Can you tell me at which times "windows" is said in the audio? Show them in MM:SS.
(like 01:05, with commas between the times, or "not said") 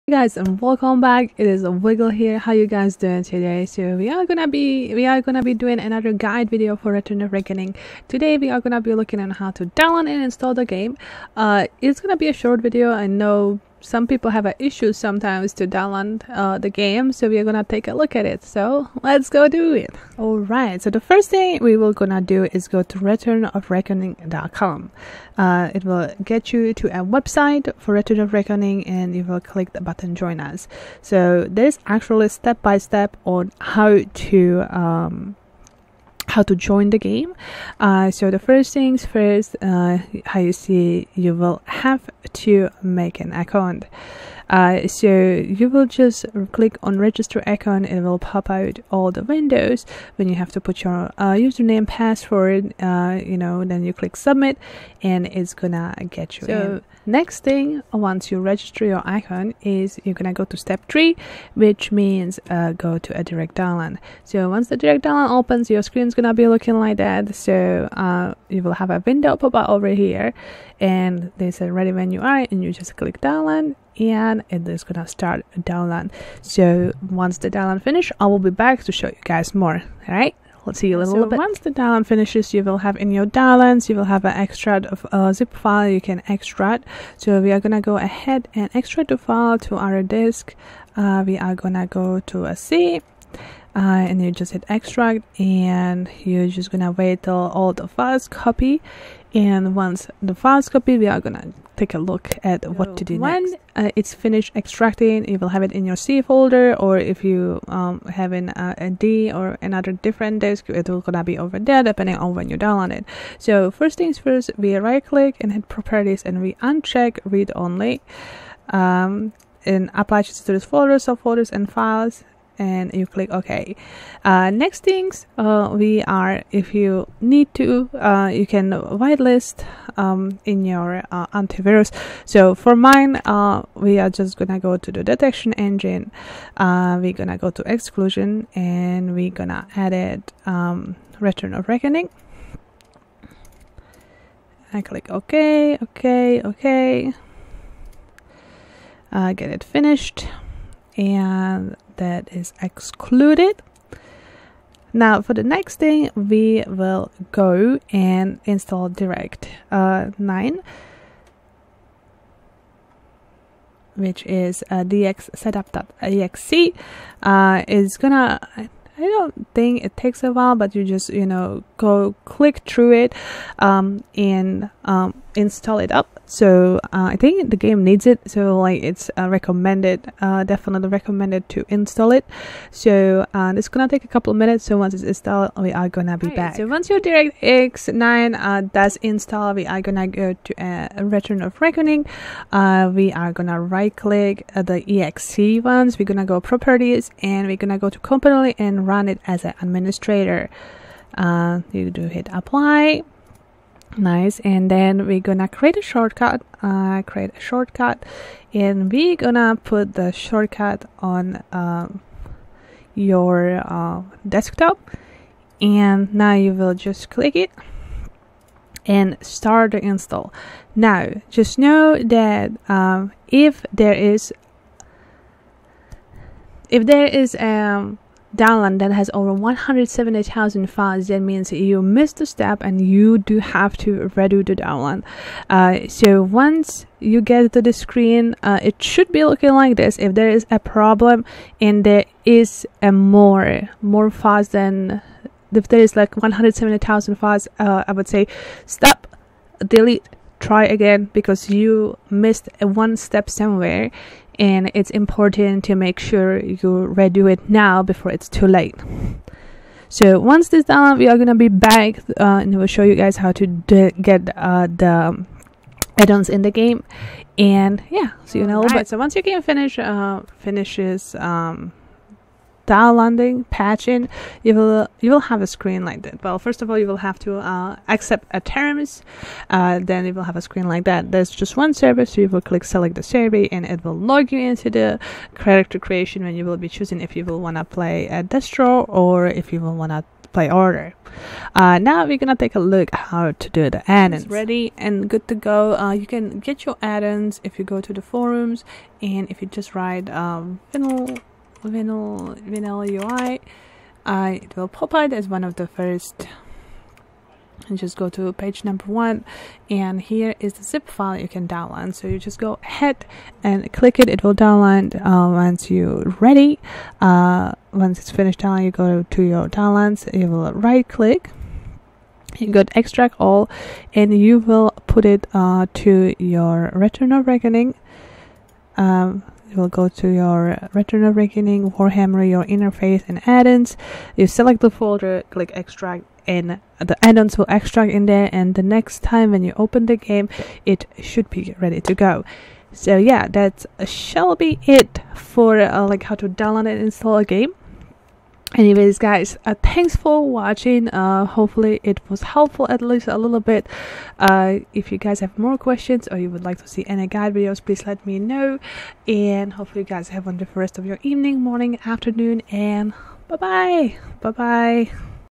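00:49, 01:09.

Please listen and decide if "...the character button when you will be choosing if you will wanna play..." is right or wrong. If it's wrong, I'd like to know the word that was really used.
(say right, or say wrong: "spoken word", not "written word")
wrong: "creation", not "button".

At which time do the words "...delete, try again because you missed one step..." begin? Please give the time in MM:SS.
04:09.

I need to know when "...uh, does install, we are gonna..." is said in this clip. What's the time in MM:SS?
03:08.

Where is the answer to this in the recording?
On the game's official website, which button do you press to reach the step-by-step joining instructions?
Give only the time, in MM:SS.
00:30.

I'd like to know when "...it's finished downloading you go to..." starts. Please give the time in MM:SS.
05:17.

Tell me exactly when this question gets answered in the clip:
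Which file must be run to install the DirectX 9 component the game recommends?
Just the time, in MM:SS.
02:44.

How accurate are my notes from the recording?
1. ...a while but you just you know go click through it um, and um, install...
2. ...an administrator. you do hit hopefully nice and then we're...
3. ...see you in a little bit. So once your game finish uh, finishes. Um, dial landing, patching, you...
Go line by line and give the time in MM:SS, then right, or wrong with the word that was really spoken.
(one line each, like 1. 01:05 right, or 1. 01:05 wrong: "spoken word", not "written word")
1. 02:50 right
2. 03:19 wrong: "apply", not "hopefully"
3. 04:28 right.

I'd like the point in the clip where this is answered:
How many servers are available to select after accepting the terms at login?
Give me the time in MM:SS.
04:41.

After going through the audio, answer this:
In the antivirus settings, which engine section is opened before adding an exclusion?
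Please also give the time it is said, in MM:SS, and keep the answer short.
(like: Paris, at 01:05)
detection engine, at 02:15.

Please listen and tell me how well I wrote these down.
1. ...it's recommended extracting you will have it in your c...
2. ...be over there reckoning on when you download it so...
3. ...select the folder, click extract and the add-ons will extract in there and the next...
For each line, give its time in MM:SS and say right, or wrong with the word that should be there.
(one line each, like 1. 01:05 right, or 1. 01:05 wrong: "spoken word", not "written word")
1. 01:43 wrong: "finished", not "recommended"
2. 01:51 wrong: "depending", not "reckoning"
3. 05:34 right.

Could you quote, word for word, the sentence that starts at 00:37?
Uh, so the first things first, uh, how you see, you will have to make an account.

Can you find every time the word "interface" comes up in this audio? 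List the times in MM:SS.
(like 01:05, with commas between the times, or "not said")
05:32.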